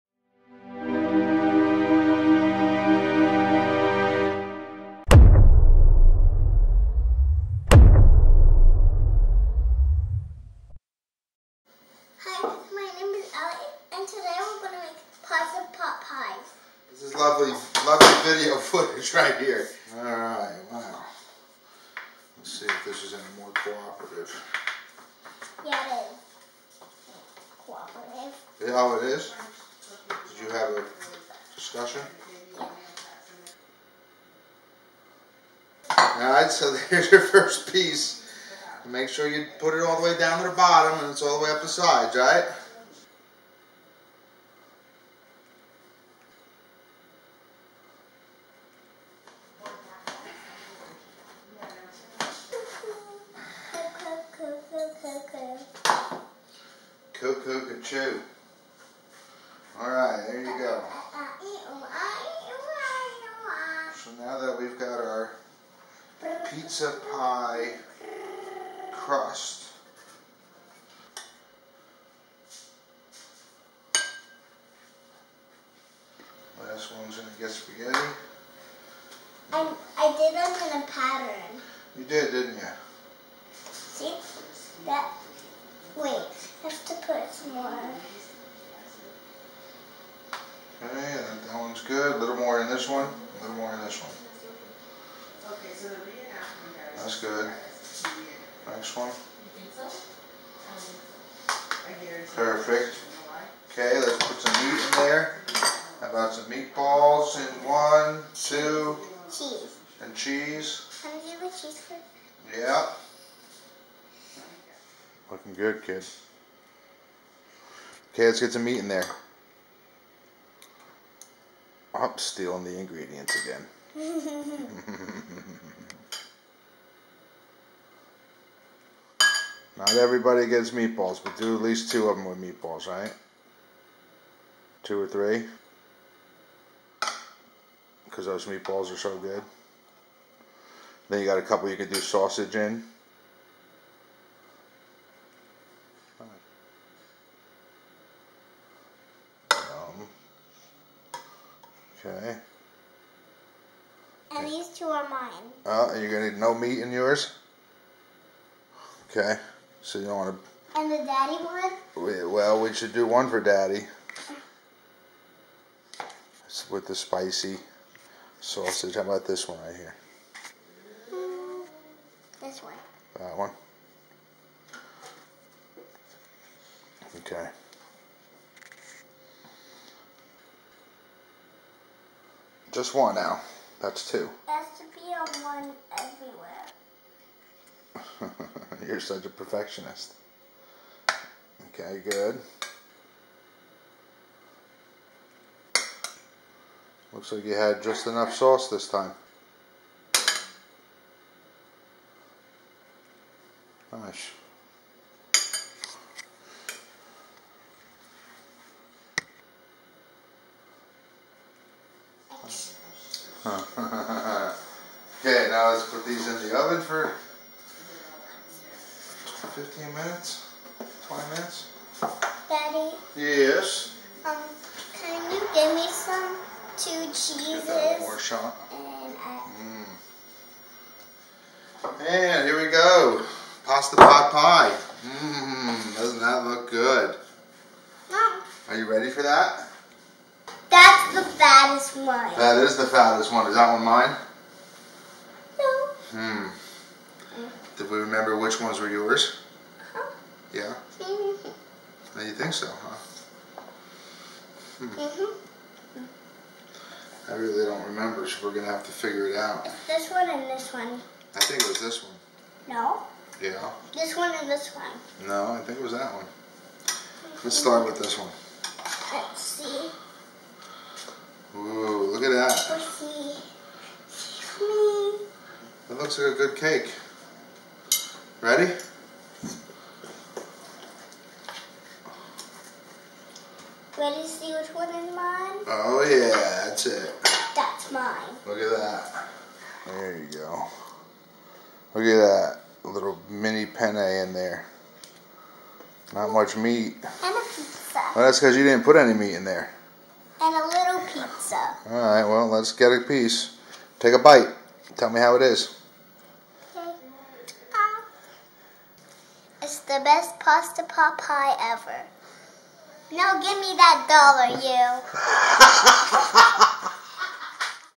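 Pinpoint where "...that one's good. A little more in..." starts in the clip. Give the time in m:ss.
1:30.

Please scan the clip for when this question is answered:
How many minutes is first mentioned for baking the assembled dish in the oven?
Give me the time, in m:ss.
3:39.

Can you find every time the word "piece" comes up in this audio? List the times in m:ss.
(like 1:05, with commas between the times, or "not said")
0:37, 5:03.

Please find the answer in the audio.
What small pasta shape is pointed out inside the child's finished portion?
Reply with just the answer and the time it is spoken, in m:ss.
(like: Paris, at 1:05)
mini penne, at 4:53.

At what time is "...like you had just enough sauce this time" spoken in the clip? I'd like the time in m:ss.
3:17.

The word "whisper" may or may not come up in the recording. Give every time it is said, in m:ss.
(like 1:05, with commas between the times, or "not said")
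not said.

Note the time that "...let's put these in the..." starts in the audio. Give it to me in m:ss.
3:35.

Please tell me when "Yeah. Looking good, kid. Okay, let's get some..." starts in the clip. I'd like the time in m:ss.
1:52.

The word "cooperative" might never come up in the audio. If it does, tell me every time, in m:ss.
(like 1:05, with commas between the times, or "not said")
0:23, 0:27.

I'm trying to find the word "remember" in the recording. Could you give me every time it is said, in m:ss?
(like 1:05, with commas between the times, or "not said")
4:07, 4:17.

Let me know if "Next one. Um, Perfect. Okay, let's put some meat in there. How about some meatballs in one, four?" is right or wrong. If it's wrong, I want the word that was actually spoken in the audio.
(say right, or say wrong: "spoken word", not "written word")
wrong: "two", not "four".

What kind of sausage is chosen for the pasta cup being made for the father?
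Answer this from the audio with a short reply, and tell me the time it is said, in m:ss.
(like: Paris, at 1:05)
spicy sausage, at 2:46.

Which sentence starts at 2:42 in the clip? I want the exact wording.
well, we should do one for daddy.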